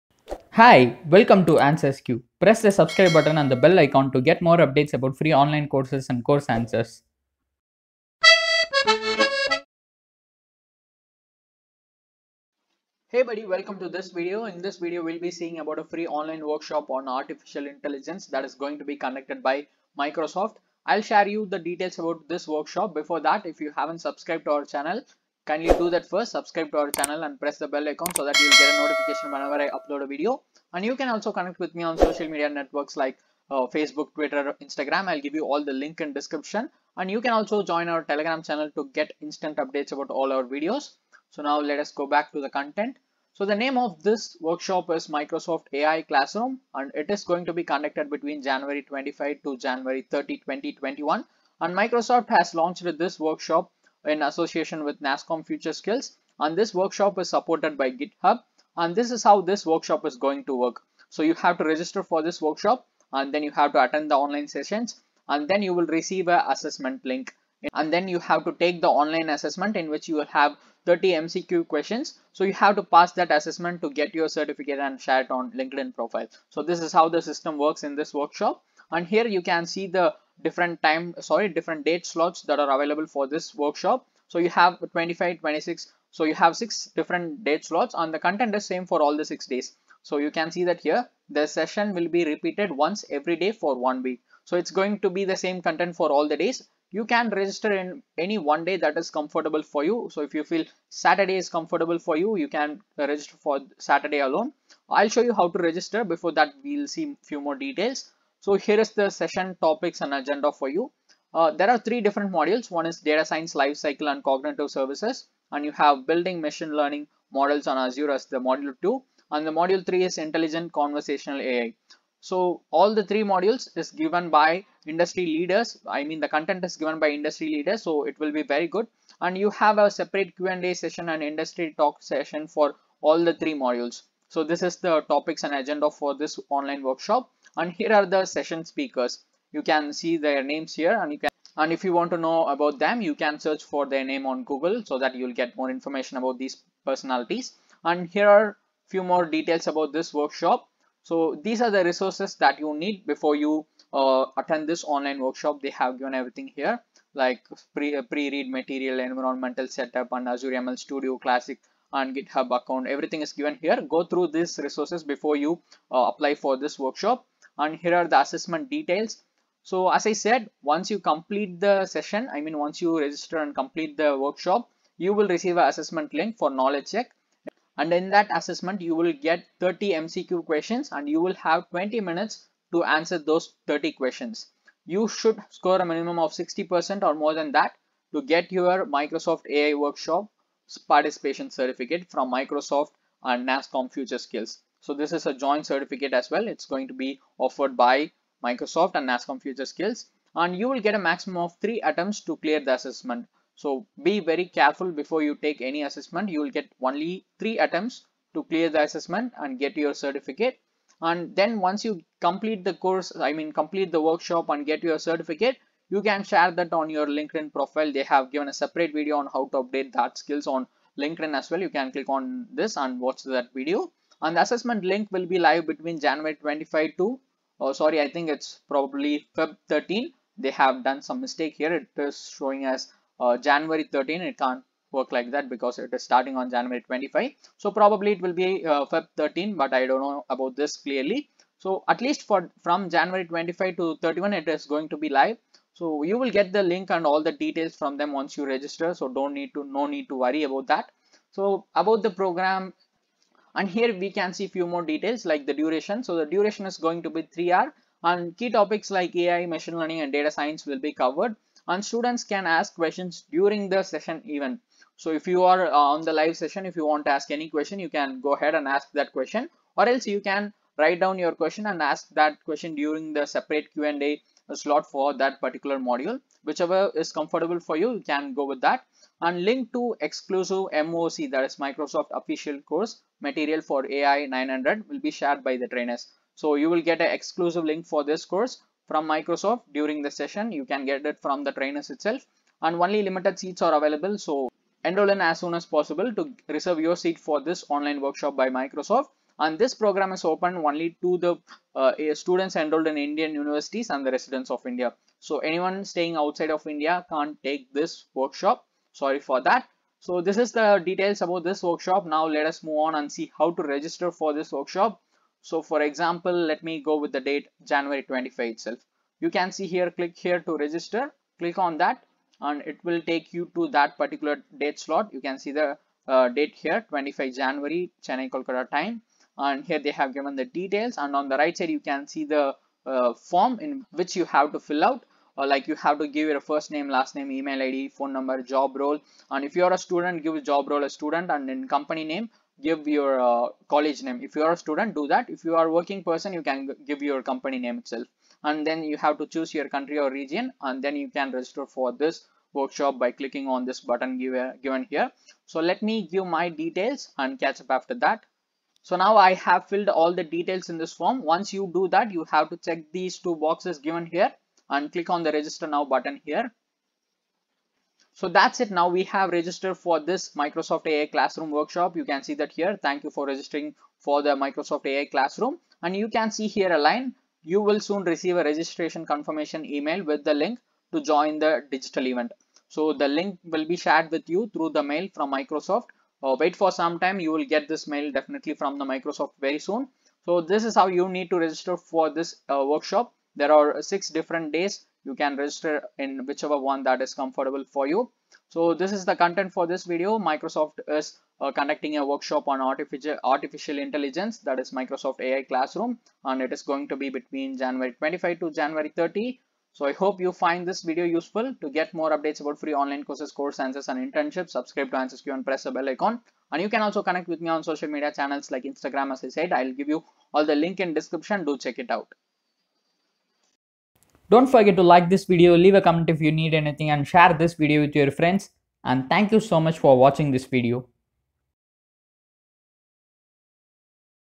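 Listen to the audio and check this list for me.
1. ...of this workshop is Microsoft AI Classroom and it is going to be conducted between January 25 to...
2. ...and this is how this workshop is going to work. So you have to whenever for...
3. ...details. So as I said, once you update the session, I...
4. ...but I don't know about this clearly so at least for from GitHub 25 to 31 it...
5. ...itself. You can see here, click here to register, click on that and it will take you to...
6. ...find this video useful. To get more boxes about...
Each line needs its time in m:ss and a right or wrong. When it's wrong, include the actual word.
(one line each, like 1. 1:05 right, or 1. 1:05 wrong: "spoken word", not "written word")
1. 0:43 right
2. 0:58 wrong: "register", not "whenever"
3. 2:48 wrong: "complete", not "update"
4. 3:59 wrong: "January", not "GitHub"
5. 5:18 right
6. 6:50 wrong: "updates", not "boxes".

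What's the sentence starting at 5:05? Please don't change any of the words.
So anyone staying outside of India can't take this workshop.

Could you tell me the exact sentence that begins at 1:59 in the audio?
And the module three is intelligent conversational AI.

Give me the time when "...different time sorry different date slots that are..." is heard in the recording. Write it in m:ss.
1:20.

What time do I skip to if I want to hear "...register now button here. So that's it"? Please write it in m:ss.
6:05.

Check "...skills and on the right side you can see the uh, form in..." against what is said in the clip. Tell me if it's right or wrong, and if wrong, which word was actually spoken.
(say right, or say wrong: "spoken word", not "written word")
wrong: "details", not "skills".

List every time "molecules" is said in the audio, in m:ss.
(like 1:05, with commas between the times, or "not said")
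not said.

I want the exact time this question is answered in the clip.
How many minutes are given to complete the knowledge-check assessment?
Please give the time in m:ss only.
3:01.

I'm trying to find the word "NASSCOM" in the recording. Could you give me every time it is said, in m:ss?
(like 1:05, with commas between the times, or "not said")
0:55, 3:13, 3:19.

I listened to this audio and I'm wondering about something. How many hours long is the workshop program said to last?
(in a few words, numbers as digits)
3.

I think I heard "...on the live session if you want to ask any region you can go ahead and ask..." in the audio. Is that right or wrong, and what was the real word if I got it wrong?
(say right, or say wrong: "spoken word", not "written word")
wrong: "question", not "region".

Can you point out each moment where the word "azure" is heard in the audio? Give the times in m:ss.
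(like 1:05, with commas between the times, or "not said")
1:57, 2:40.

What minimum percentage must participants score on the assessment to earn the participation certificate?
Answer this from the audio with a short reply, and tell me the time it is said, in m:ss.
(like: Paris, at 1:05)
60%, at 3:06.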